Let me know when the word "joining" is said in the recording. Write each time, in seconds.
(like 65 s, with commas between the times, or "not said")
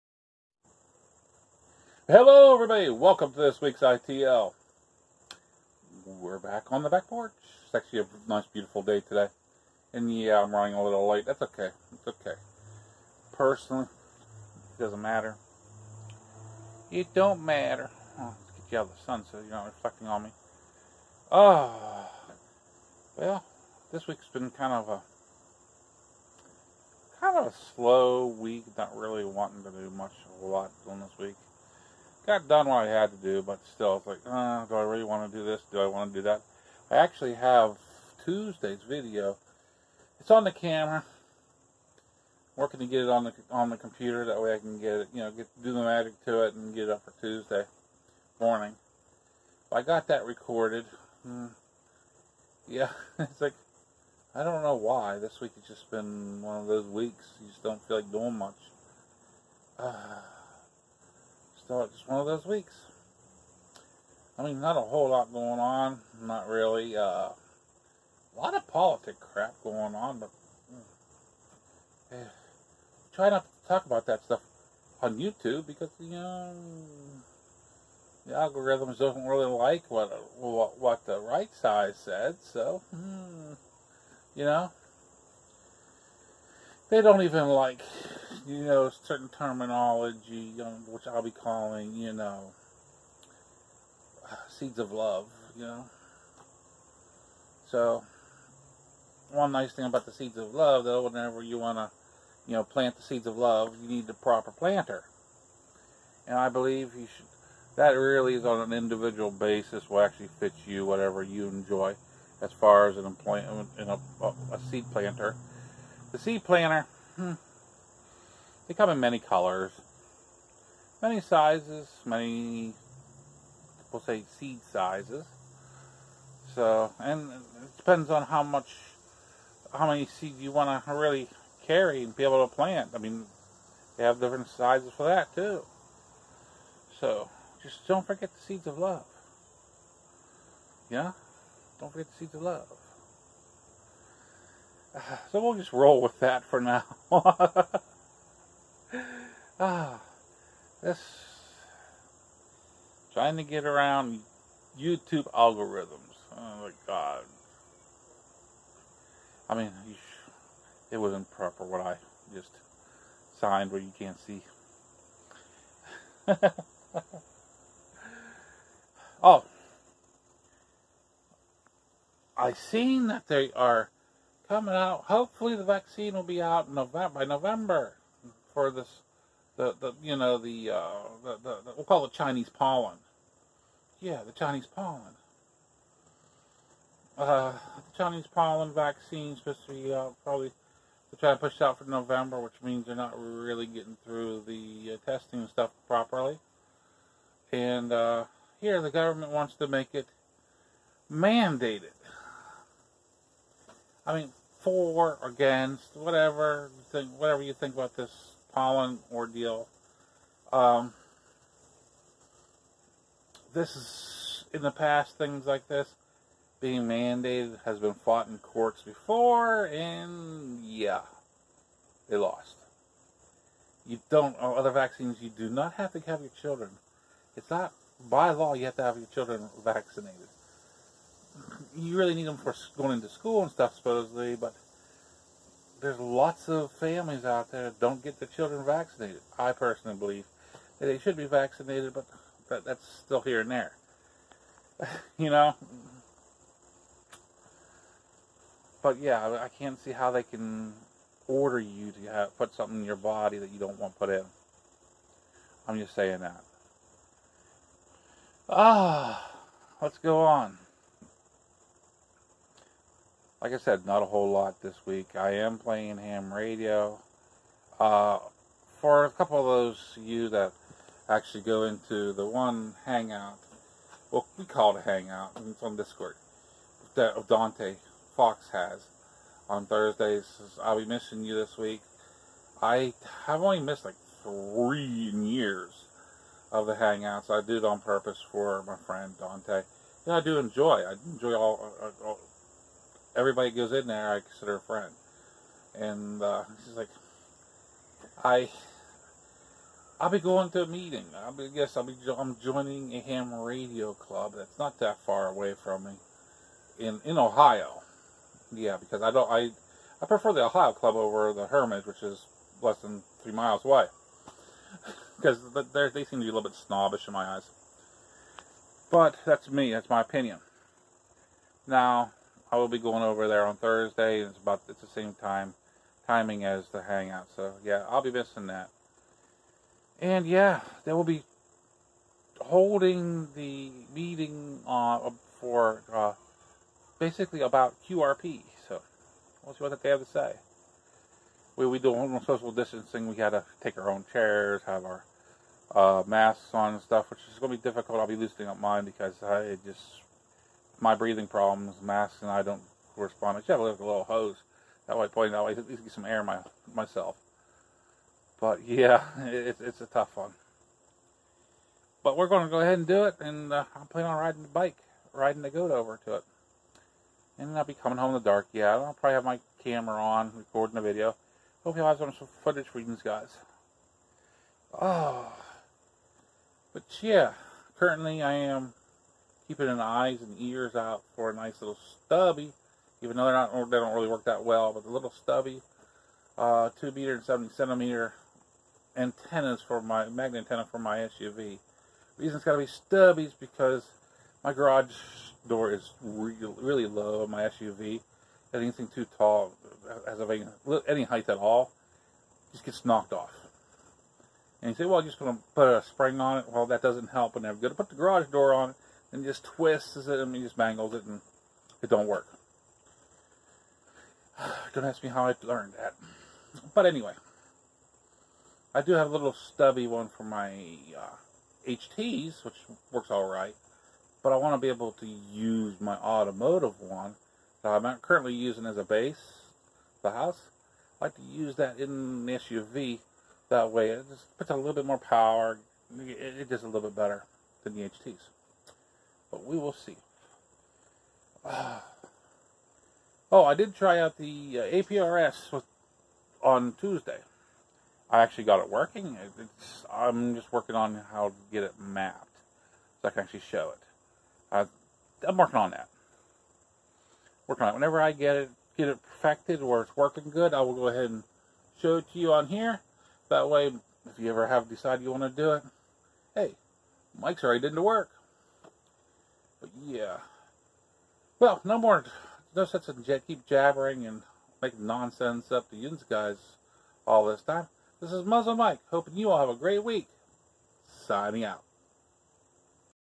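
302 s.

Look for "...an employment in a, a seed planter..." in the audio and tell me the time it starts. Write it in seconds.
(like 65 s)
112 s.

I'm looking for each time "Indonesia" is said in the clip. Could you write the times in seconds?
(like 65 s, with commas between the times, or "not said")
not said.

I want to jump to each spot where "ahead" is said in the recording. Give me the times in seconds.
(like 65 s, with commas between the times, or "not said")
362 s, 460 s.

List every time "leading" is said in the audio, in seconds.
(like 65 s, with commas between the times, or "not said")
not said.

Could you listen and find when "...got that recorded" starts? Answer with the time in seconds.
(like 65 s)
49 s.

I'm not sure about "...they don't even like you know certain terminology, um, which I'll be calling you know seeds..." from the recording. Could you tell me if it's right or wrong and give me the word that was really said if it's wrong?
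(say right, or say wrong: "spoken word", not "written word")
right.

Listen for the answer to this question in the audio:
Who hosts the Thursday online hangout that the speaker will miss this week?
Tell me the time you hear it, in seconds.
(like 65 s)
277 s.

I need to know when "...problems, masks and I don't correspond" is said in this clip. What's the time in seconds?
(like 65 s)
351 s.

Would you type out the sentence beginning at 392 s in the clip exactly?
The reason it's got to be stubby is because my garage door is really low on my SUV.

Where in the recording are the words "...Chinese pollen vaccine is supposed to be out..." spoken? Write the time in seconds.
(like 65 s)
188 s.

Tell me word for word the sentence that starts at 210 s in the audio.
Um, this is in the past things like this being mandated has been fought in courts before, and yeah, they lost.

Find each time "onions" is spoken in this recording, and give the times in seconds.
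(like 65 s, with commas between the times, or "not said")
not said.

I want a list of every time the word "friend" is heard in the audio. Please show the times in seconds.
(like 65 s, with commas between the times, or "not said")
288 s, 294 s.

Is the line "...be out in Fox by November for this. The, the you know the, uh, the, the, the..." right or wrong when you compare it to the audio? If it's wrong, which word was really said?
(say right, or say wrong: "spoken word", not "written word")
wrong: "November", not "Fox".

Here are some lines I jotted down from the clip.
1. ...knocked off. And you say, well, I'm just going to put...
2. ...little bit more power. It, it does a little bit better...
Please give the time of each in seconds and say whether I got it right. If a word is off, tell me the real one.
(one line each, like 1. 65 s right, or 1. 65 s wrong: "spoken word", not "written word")
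1. 402 s right
2. 434 s right.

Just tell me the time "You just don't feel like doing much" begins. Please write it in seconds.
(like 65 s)
57 s.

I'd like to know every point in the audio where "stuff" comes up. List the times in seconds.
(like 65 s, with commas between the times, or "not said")
74 s, 195 s, 233 s, 346 s.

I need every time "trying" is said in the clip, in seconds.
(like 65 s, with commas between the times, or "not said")
153 s, 191 s.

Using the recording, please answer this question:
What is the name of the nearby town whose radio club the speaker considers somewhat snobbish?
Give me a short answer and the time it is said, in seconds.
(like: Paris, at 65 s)
Hermitage, at 311 s.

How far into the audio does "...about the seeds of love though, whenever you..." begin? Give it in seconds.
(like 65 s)
99 s.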